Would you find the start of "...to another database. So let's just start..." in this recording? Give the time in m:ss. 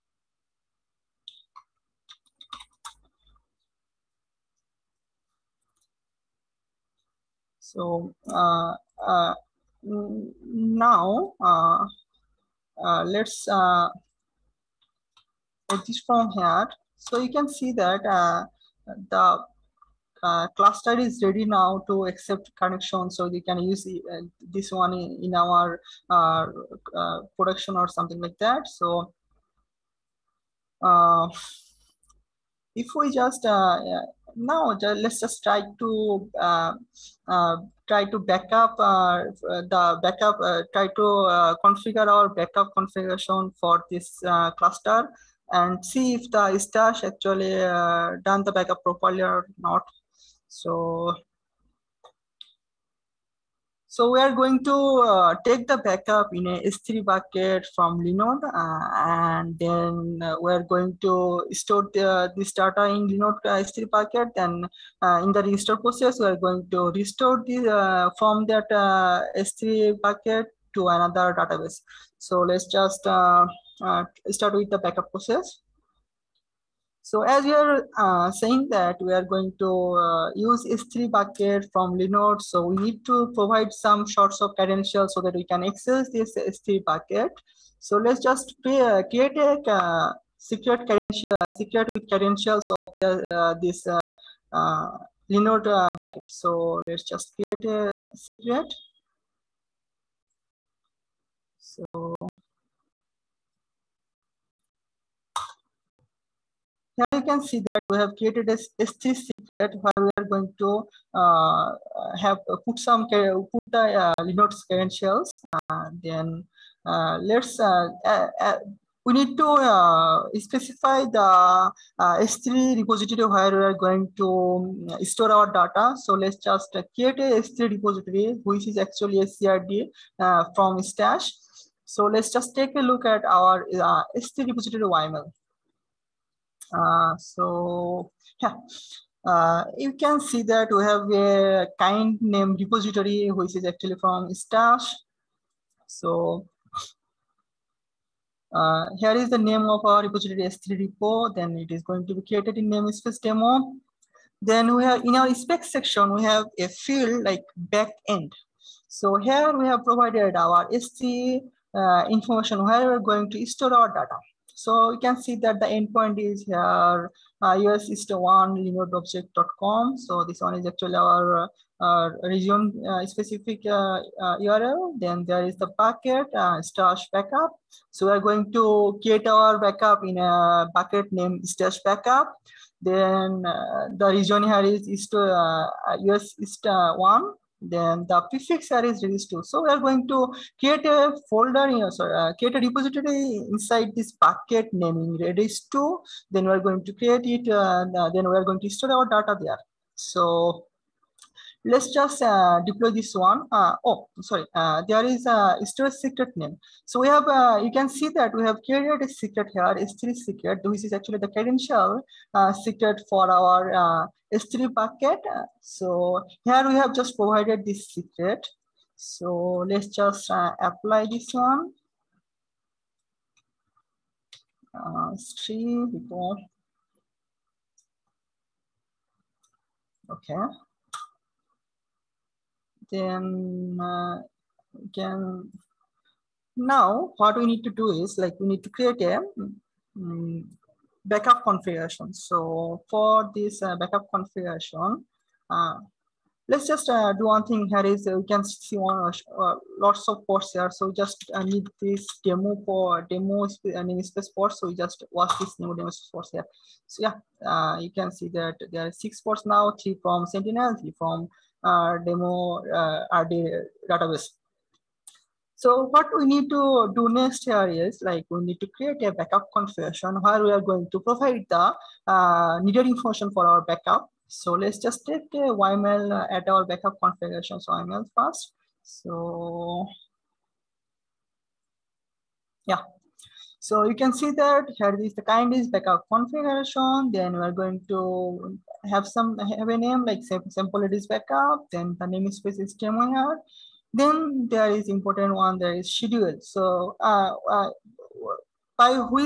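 1:10.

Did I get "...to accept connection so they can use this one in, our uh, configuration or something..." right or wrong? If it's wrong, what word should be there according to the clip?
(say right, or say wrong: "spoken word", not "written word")
wrong: "production", not "configuration".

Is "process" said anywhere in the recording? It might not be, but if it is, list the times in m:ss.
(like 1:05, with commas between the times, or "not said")
1:05, 1:15.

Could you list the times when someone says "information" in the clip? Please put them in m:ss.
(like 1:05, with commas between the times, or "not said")
2:42, 4:32.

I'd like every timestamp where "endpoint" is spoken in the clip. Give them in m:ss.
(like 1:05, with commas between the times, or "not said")
2:45.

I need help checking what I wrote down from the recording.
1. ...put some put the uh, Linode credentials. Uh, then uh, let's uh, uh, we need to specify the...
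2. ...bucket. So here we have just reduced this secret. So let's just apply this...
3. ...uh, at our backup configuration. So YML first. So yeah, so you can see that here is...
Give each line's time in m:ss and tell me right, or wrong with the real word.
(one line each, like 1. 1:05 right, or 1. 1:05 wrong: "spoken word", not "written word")
1. 1:52 right
2. 3:34 wrong: "provided", not "reduced"
3. 4:36 right.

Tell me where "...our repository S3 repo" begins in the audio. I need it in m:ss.
2:29.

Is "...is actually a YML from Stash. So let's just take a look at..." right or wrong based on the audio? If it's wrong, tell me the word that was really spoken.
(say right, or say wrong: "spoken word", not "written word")
wrong: "CRD", not "YML".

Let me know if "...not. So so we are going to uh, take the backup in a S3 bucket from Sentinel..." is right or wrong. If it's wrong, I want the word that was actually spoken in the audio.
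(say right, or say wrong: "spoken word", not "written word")
wrong: "Linode", not "Sentinel".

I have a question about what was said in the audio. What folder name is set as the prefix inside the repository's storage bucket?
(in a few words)
redis2.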